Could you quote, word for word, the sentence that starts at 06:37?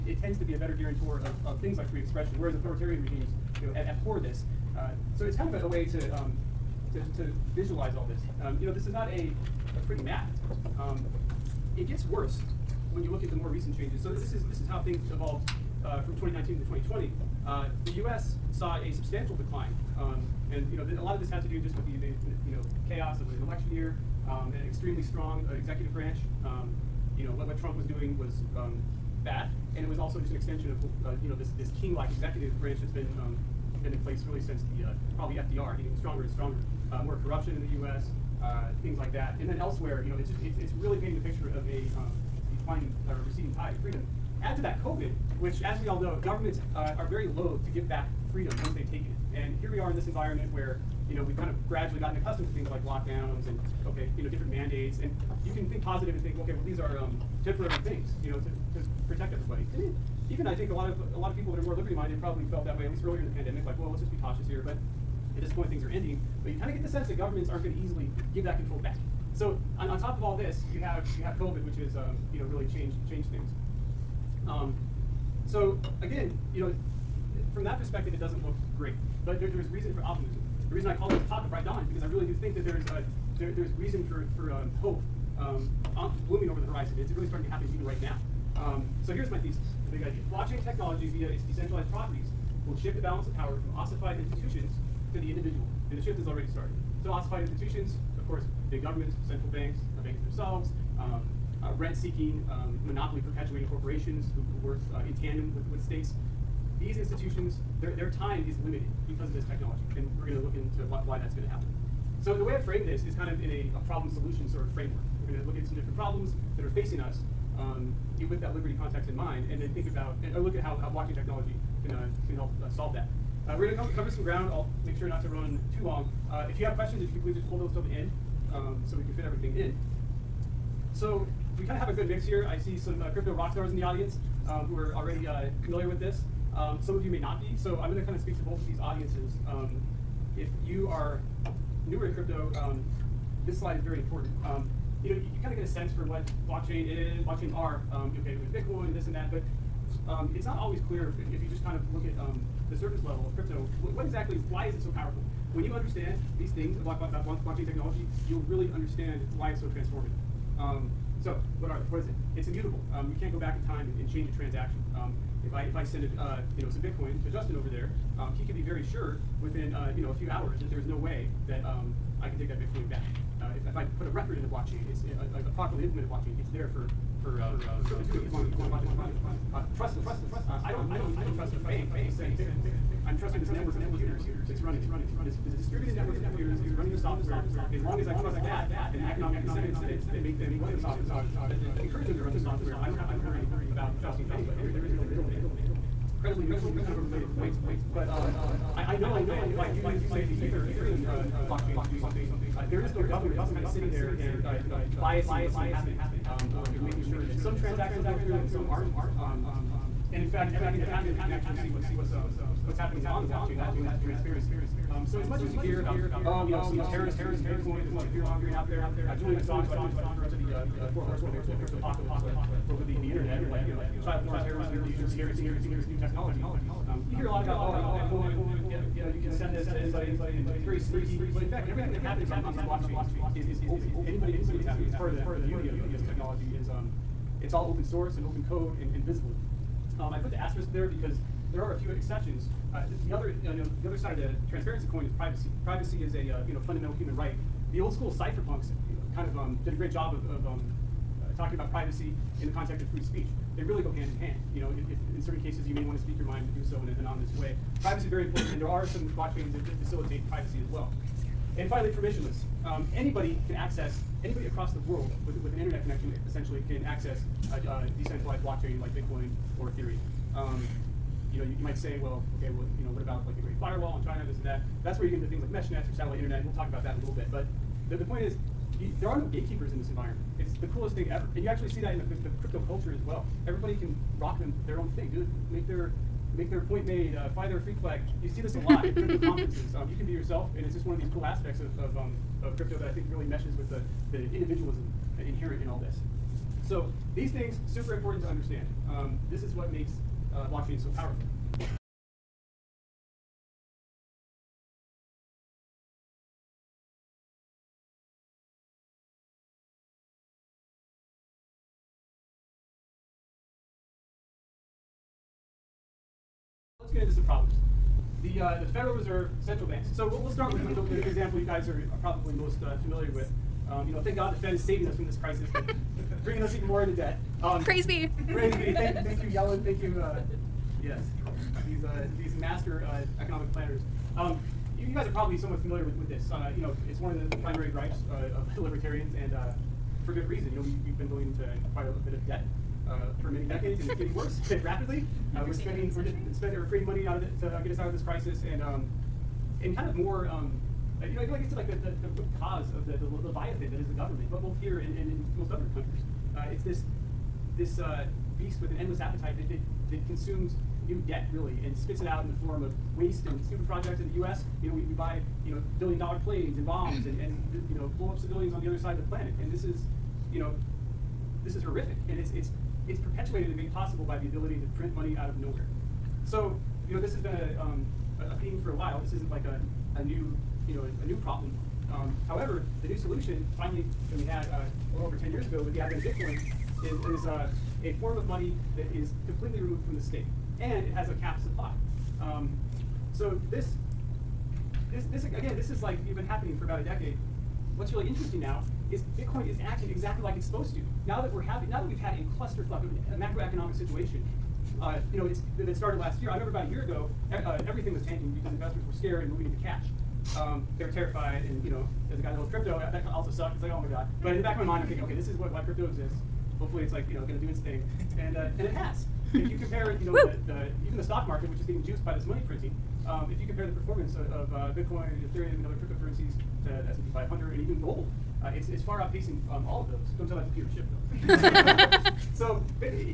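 What's really interesting now is Bitcoin is acting exactly like it's supposed to.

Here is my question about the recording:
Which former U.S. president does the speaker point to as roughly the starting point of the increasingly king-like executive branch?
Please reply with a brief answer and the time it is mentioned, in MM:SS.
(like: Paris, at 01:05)
FDR, at 00:35.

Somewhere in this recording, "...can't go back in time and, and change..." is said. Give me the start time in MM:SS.
02:43.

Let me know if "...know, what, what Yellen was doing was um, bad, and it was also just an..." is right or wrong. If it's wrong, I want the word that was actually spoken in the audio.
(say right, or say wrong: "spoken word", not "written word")
wrong: "Trump", not "Yellen".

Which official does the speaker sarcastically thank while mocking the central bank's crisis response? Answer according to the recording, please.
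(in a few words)
Yellen.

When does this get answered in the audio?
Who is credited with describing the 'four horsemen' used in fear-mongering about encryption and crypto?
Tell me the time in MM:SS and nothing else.
03:39.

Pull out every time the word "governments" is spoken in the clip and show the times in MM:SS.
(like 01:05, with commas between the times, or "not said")
00:46, 01:07, 01:38, 03:23, 05:53.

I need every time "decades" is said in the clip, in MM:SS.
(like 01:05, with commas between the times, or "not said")
05:43, 06:36.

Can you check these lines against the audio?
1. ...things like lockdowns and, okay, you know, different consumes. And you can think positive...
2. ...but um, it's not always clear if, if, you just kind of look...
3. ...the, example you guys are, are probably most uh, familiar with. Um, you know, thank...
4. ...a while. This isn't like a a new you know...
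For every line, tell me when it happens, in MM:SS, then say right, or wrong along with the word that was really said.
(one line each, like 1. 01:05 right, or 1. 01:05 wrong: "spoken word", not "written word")
1. 00:52 wrong: "mandates", not "consumes"
2. 02:29 right
3. 05:21 right
4. 06:18 right.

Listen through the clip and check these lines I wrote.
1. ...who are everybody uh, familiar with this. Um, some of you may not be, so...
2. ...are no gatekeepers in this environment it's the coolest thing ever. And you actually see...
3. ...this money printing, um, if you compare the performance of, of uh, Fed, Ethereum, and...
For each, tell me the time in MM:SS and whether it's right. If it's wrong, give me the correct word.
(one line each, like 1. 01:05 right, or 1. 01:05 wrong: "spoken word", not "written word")
1. 02:14 wrong: "already", not "everybody"
2. 04:39 right
3. 07:02 wrong: "Bitcoin", not "Fed".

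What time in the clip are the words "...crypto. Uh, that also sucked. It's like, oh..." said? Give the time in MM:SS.
06:52.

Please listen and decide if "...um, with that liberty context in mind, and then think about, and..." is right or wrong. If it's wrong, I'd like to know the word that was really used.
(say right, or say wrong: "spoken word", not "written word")
right.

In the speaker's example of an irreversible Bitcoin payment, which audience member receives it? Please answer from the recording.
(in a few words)
Justin.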